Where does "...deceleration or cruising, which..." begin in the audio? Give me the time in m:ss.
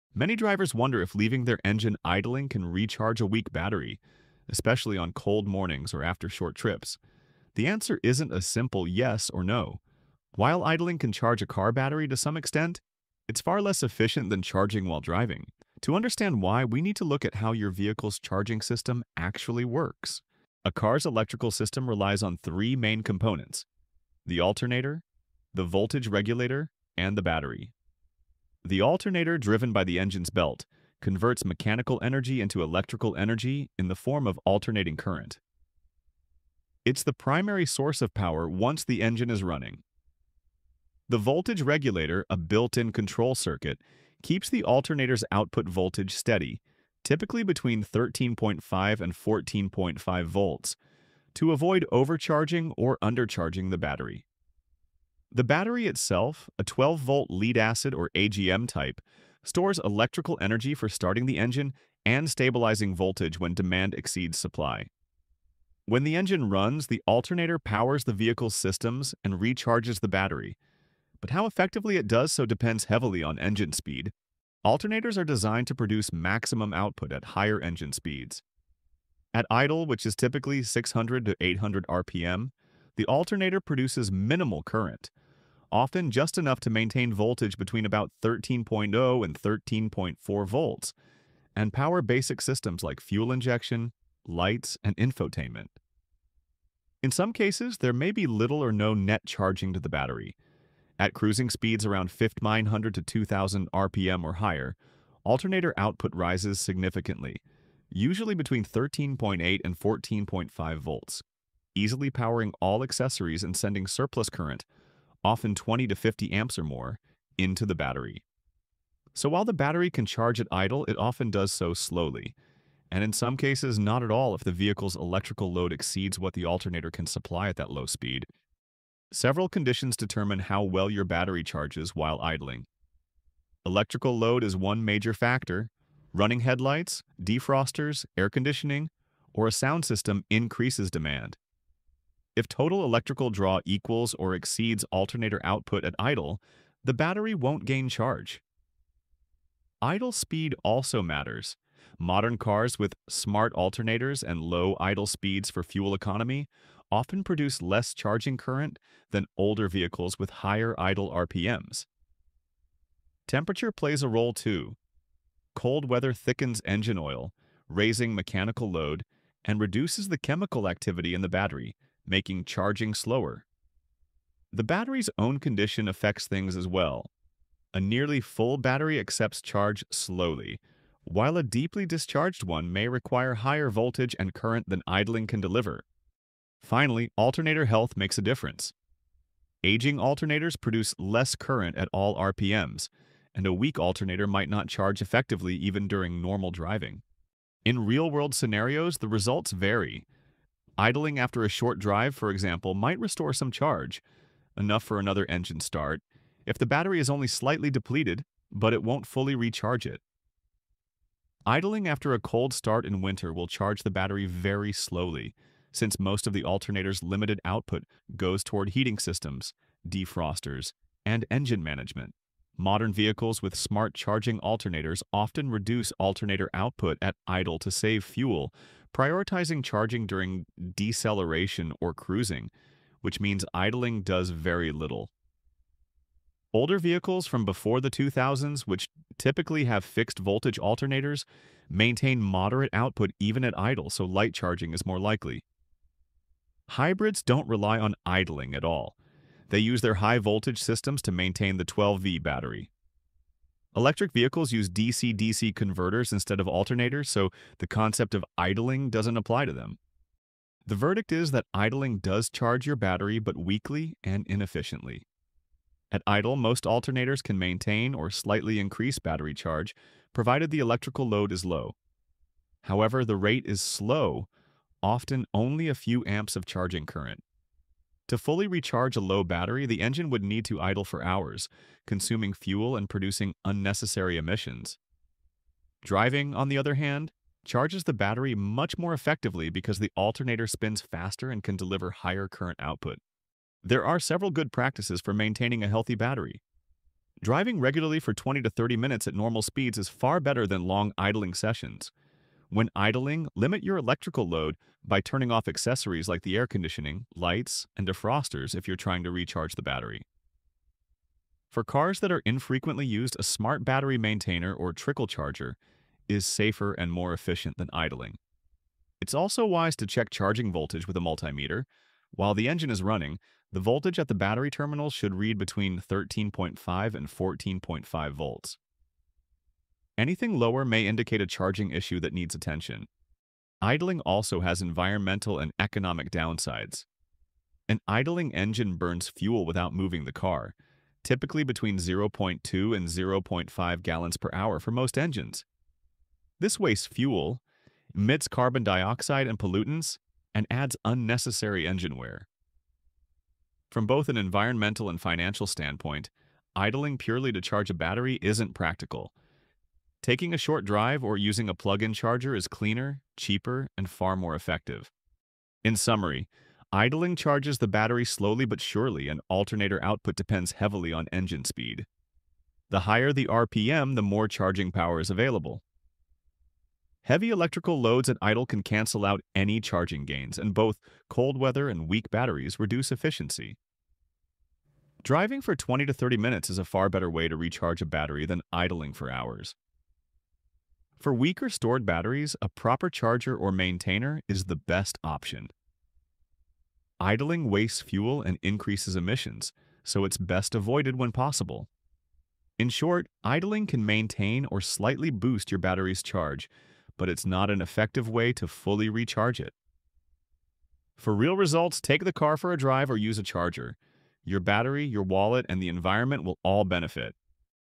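3:50.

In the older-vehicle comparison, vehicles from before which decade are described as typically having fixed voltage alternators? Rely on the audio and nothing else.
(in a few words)
2000s.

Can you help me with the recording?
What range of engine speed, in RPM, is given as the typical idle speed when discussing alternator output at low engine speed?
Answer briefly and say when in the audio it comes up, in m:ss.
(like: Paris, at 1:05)
600 to 800, at 1:20.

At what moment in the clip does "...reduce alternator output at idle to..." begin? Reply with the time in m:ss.
3:45.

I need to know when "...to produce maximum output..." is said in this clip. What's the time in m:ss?
1:15.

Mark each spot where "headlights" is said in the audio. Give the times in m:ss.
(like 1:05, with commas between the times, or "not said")
2:16.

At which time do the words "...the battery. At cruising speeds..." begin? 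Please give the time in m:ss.
1:39.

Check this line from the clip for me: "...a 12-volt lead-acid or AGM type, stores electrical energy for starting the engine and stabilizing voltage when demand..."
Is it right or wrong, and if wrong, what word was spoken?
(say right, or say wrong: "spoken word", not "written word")
right.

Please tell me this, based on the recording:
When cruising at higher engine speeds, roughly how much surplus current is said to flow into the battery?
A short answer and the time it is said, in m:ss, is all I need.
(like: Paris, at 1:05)
20 to 50 amps, at 1:55.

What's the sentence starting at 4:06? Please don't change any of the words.
Hybrids don't rely on idling at all.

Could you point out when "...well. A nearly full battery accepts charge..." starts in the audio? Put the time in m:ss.
2:56.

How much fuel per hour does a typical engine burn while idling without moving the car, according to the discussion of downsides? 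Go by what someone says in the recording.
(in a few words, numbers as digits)
0.2 to 0.5 gallons.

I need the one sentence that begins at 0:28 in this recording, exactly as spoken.
The alternator driven by the engine's belt converts mechanical energy into electrical energy in the form of alternating current.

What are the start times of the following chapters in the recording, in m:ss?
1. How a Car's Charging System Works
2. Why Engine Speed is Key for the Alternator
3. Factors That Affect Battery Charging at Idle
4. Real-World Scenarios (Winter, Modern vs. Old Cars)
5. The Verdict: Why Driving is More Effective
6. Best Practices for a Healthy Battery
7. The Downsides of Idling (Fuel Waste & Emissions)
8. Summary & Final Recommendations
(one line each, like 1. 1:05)
1. 0:20
2. 1:14
3. 2:09
4. 3:17
5. 4:20
6. 4:53
7. 5:33
8. 6:05.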